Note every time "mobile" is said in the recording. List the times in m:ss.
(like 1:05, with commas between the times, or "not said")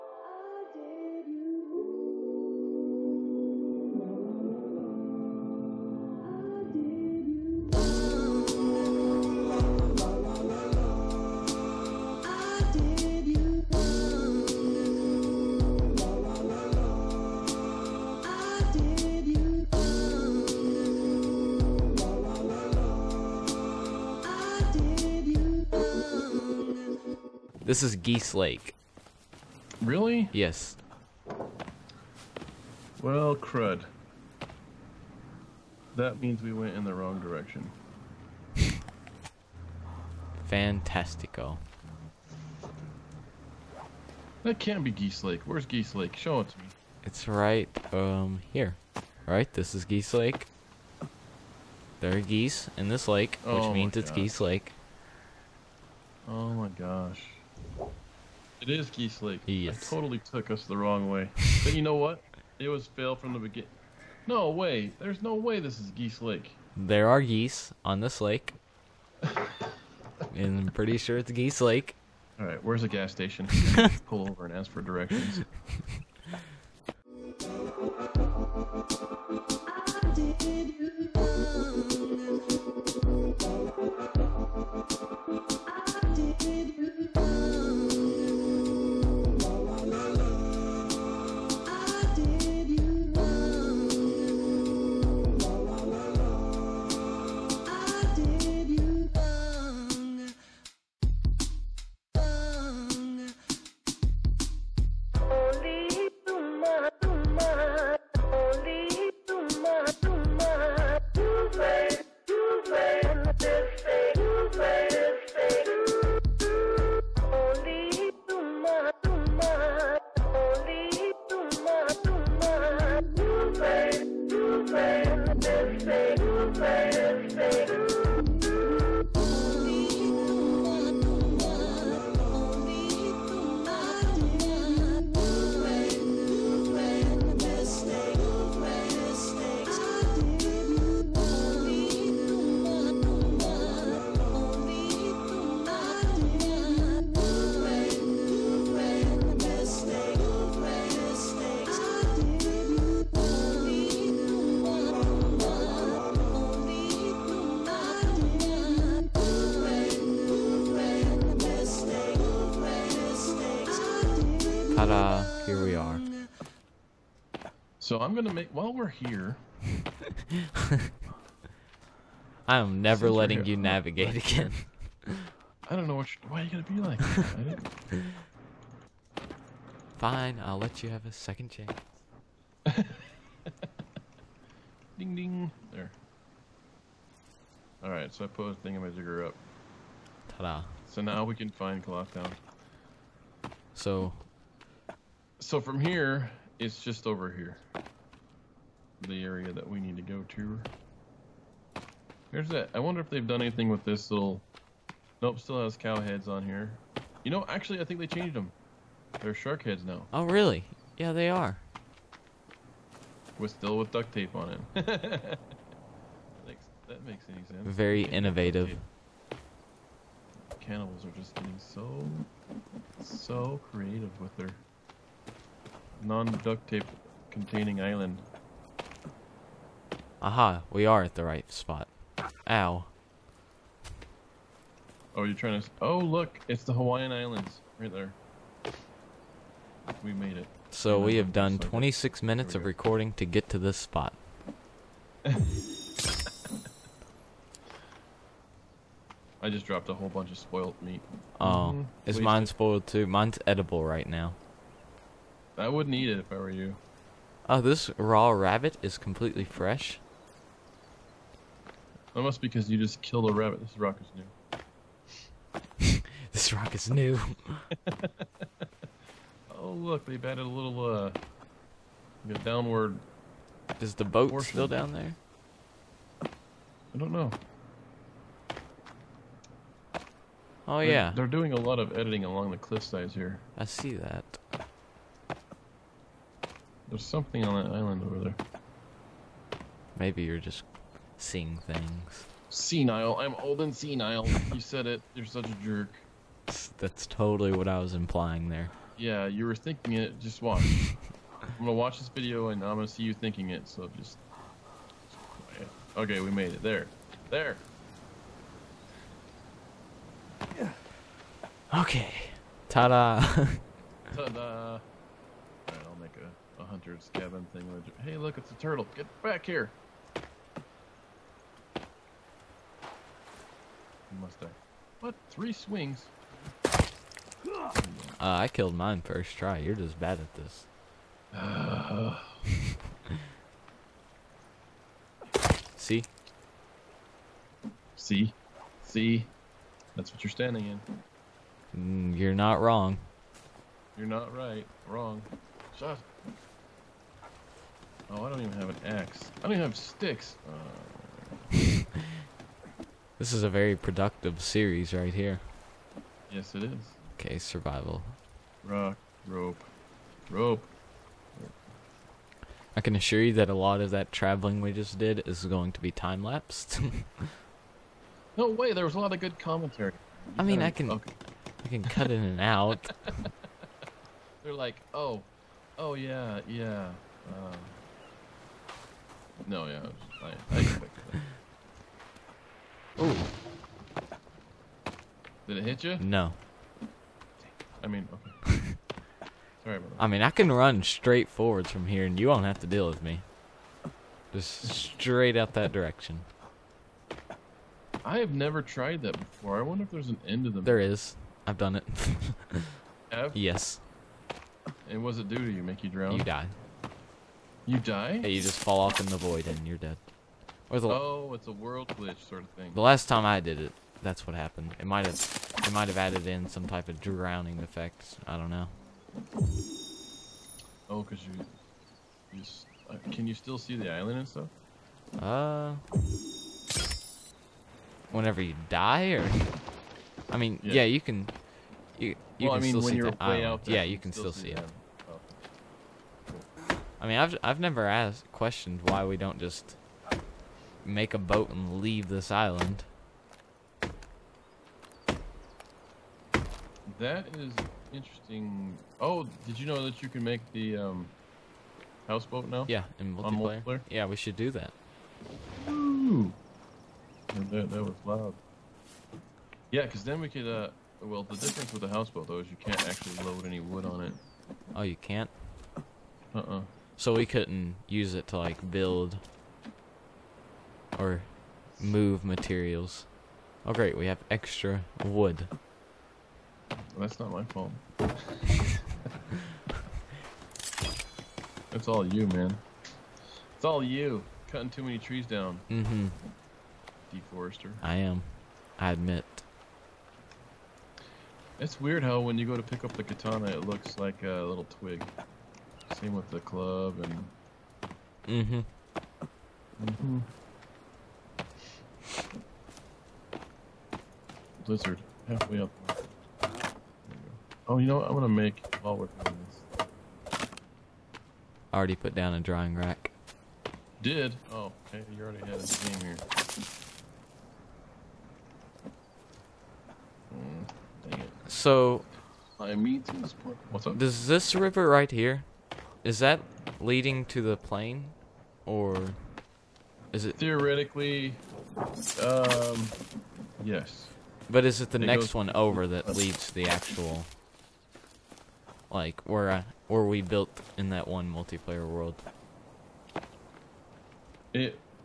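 not said.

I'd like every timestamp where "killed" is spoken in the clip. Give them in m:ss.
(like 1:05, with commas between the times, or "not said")
4:23, 5:28.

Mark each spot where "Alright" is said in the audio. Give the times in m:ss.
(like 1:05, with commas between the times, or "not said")
3:07, 5:14.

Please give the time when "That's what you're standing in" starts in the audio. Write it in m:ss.
5:39.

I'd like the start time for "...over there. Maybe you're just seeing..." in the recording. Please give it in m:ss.
4:48.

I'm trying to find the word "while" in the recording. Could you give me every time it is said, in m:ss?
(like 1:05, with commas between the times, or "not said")
2:48, 8:28.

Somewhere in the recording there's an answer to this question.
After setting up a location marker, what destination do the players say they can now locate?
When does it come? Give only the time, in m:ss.
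3:11.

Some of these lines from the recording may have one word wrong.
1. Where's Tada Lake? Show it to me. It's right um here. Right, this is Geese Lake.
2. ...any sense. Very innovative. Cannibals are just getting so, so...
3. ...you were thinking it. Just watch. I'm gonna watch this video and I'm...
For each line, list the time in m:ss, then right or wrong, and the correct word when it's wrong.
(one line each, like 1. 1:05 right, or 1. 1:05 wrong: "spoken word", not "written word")
1. 0:45 wrong: "Geese", not "Tada"
2. 3:37 right
3. 4:59 right.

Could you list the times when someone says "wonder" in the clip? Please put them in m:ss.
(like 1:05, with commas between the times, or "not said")
3:22, 6:39.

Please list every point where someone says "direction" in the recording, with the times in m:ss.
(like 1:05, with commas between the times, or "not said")
0:37, 1:14, 6:35.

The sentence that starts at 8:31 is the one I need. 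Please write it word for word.
I already put down a drawing rack.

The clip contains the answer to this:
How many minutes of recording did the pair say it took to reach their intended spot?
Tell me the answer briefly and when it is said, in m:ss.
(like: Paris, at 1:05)
26, at 4:01.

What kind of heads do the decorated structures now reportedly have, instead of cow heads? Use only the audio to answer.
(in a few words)
Shark heads.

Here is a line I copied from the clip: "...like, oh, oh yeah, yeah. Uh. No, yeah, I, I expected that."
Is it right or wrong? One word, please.
right.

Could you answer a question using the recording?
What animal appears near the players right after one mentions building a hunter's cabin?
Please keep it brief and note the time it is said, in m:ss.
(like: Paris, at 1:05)
A turtle, at 5:18.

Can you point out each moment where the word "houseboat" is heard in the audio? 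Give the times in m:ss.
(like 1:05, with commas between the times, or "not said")
7:32, 7:41.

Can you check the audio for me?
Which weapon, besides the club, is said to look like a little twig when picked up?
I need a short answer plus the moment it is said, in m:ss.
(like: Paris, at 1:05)
Katana, at 8:13.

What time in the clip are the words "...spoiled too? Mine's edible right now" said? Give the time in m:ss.
4:12.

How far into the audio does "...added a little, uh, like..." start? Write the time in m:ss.
4:30.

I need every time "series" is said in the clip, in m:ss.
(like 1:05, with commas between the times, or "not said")
5:54.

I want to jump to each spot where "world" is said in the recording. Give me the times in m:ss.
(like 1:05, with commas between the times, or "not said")
6:51, 9:01.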